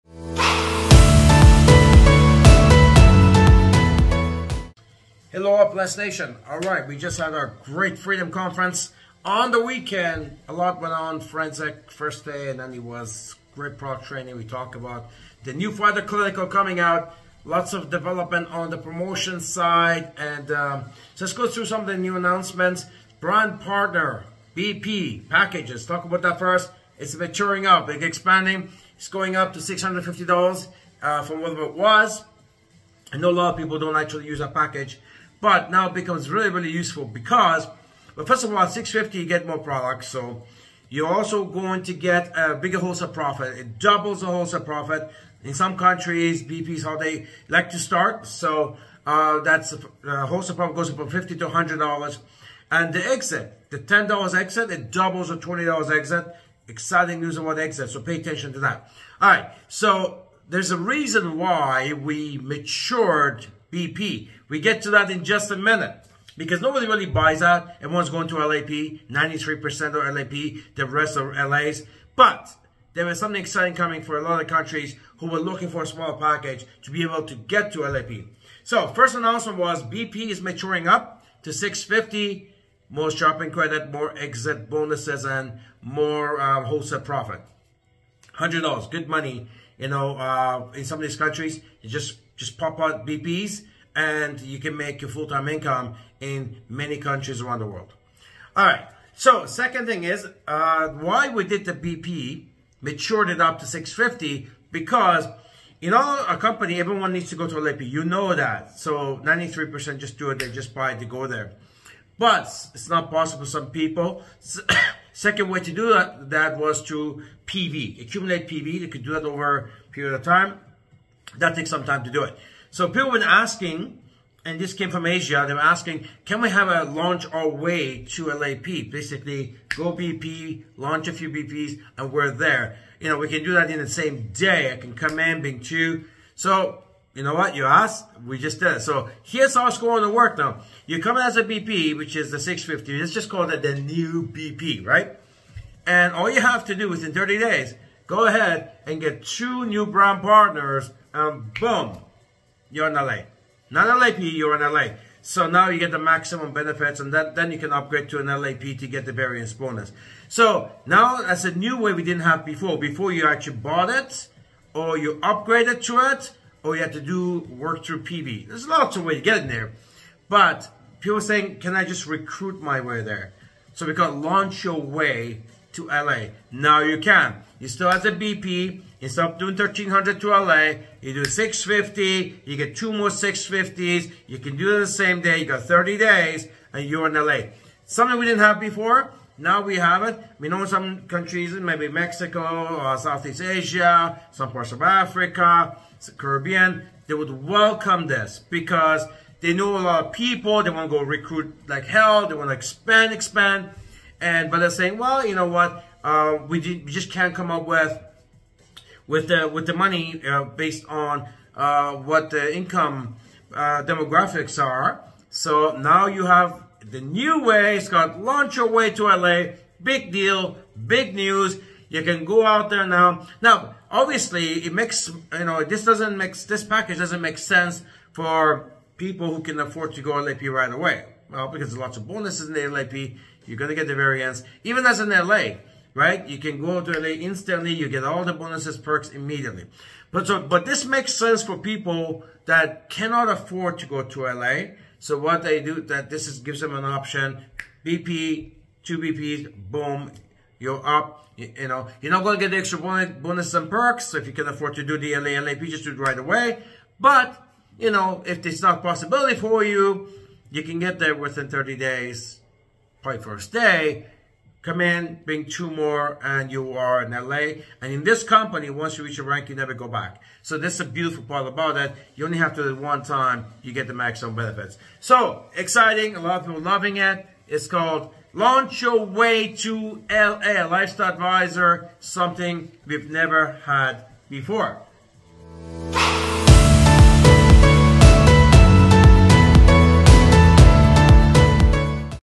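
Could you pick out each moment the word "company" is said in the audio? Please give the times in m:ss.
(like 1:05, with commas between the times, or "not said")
1:46, 4:28.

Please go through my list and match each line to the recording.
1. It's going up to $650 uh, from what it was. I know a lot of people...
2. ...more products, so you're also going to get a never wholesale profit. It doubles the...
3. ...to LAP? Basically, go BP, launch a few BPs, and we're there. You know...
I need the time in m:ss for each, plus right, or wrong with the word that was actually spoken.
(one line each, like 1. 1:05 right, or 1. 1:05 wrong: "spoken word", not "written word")
1. 0:28 right
2. 0:39 wrong: "bigger", not "never"
3. 2:08 right.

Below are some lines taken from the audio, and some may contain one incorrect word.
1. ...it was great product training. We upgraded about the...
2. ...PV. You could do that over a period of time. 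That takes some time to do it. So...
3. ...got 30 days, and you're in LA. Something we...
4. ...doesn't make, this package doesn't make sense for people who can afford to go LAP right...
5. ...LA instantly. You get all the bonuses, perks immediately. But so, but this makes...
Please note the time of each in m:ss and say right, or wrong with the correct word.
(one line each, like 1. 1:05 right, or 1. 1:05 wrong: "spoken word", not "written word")
1. 0:12 wrong: "talked", not "upgraded"
2. 1:58 right
3. 3:05 right
4. 3:45 right
5. 3:56 right.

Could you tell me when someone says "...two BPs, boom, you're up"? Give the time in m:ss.
4:08.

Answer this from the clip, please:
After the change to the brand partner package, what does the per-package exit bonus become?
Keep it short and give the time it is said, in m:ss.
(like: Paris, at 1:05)
$20, at 0:55.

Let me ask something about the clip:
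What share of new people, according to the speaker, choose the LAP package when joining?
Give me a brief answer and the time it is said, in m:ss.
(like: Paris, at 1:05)
93%, at 1:09.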